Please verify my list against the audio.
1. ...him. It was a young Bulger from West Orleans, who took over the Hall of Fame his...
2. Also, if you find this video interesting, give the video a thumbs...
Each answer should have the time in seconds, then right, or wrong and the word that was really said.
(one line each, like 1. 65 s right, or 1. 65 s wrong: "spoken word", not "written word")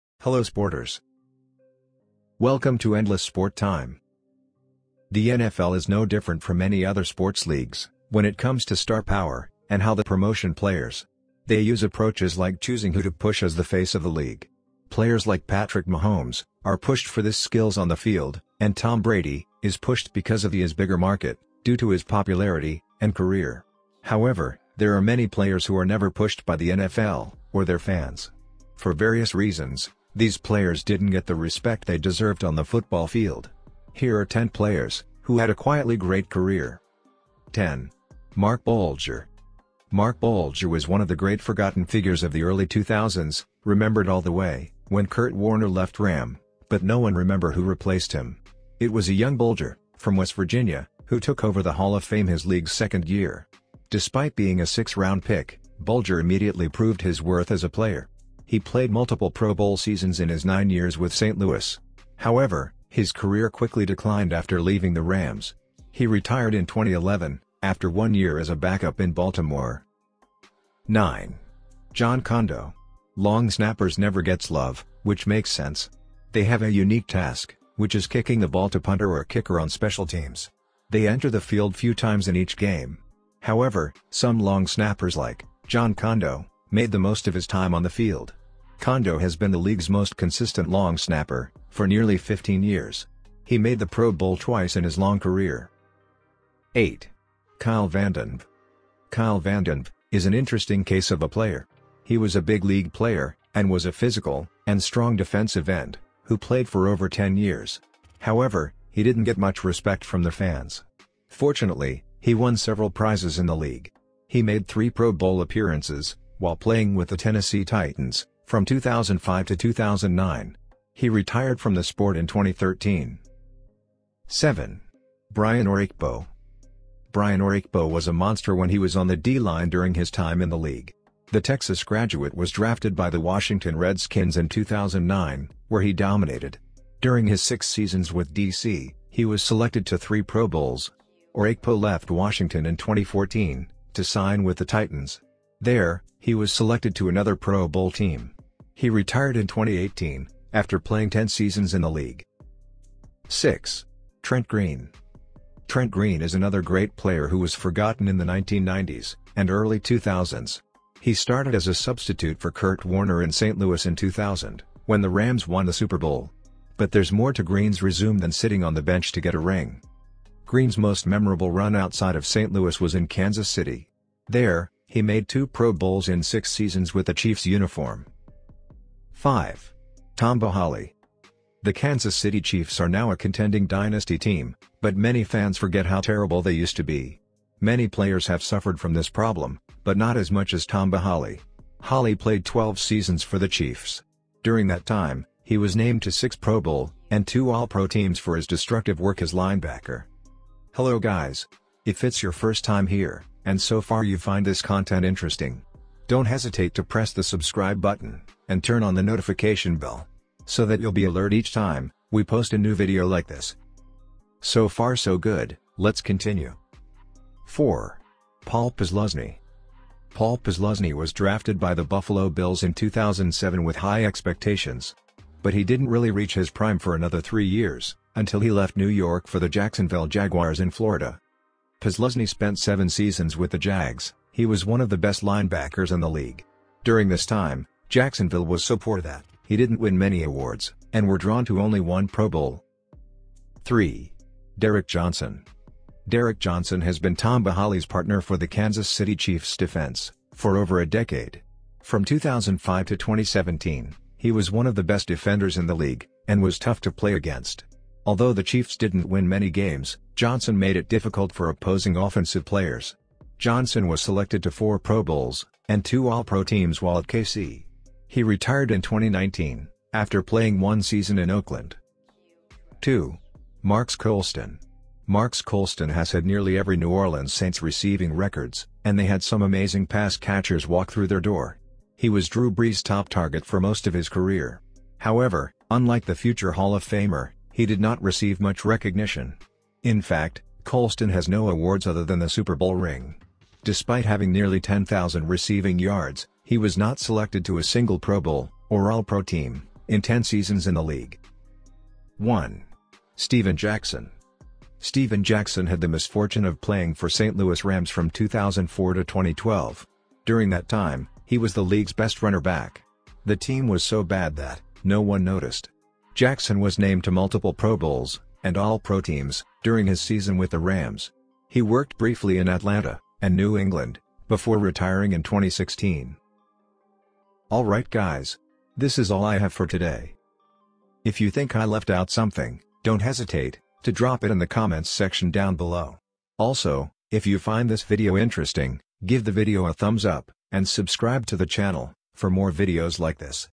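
1. 48 s wrong: "Virginia", not "Orleans"
2. 336 s right.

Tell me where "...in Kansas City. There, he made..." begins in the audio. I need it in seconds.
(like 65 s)
172 s.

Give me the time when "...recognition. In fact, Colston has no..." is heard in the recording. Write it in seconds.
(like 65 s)
288 s.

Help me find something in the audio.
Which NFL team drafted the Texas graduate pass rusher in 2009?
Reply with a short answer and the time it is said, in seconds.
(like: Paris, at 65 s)
Washington Redskins, at 133 s.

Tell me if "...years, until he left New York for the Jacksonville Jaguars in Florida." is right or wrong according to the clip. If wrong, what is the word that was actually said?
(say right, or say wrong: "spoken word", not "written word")
right.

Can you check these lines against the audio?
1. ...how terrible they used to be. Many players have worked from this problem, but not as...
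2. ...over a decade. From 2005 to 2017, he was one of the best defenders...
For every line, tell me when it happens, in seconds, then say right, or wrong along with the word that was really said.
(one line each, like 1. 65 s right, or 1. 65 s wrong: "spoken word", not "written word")
1. 185 s wrong: "suffered", not "worked"
2. 250 s right.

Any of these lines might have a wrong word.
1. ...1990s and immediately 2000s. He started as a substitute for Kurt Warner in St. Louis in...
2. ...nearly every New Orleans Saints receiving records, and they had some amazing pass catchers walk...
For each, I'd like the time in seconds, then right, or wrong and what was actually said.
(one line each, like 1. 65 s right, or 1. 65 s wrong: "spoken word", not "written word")
1. 158 s wrong: "early", not "immediately"
2. 276 s right.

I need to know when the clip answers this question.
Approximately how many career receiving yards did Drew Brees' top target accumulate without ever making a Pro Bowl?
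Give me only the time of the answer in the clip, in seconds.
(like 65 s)
294 s.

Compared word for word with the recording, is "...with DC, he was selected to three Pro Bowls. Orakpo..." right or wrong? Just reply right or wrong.
right.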